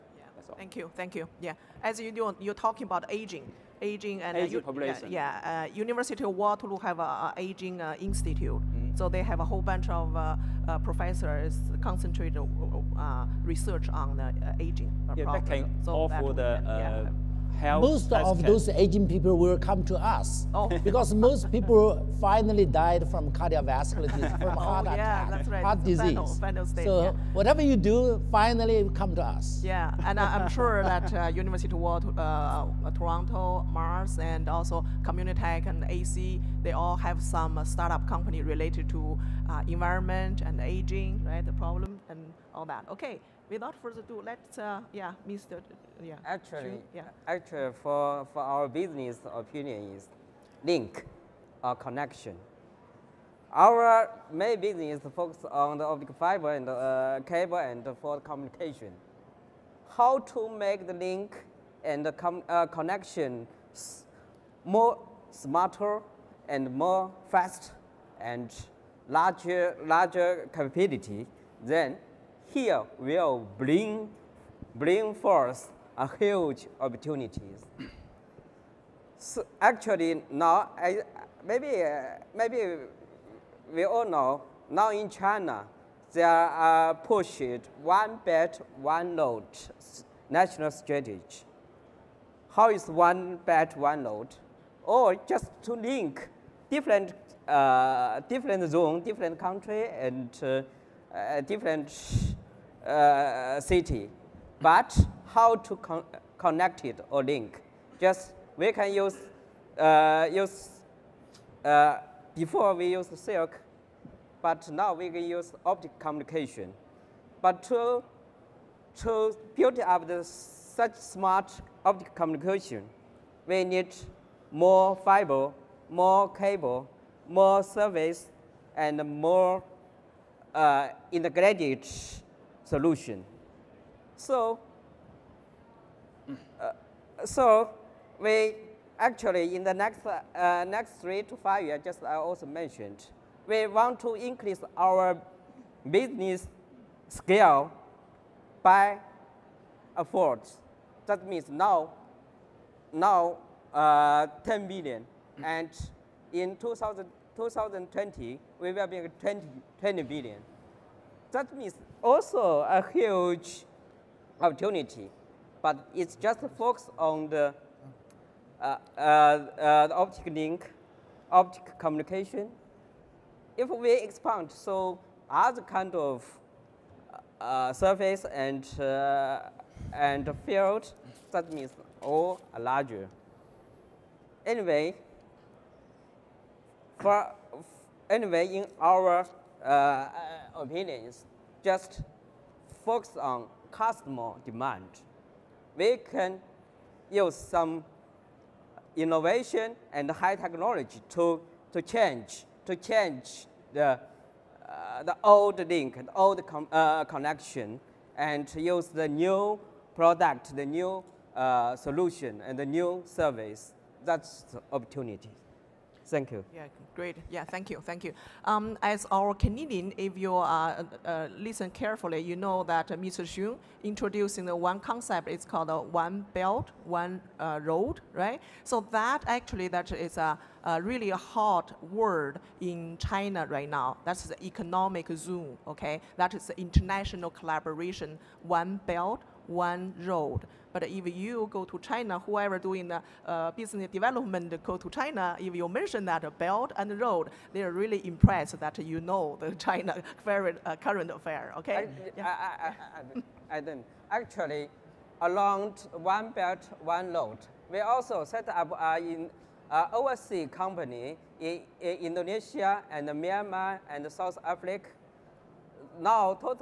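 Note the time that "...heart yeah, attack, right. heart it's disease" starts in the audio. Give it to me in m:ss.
0:24.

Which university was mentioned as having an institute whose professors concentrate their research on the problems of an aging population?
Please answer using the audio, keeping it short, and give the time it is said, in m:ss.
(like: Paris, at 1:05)
University of Waterloo, at 0:05.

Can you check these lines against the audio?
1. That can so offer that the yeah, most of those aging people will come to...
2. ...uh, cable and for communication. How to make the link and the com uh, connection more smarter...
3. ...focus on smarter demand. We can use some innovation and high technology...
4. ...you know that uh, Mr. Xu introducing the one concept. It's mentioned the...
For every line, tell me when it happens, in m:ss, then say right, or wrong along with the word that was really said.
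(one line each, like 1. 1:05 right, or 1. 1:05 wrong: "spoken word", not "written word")
1. 0:15 right
2. 0:56 right
3. 3:12 wrong: "customer", not "smarter"
4. 3:42 wrong: "called", not "mentioned".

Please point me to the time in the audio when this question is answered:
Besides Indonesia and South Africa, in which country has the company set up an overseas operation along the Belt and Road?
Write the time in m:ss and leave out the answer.
4:23.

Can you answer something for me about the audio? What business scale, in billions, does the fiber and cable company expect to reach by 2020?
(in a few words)
20 billion.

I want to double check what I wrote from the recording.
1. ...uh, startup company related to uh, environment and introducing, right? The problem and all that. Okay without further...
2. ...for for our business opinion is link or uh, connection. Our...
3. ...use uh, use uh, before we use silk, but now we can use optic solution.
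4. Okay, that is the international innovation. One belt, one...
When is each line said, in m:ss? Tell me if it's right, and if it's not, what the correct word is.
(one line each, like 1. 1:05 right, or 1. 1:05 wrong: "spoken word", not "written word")
1. 0:37 wrong: "aging", not "introducing"
2. 0:47 right
3. 1:48 wrong: "communication", not "solution"
4. 3:55 wrong: "collaboration", not "innovation".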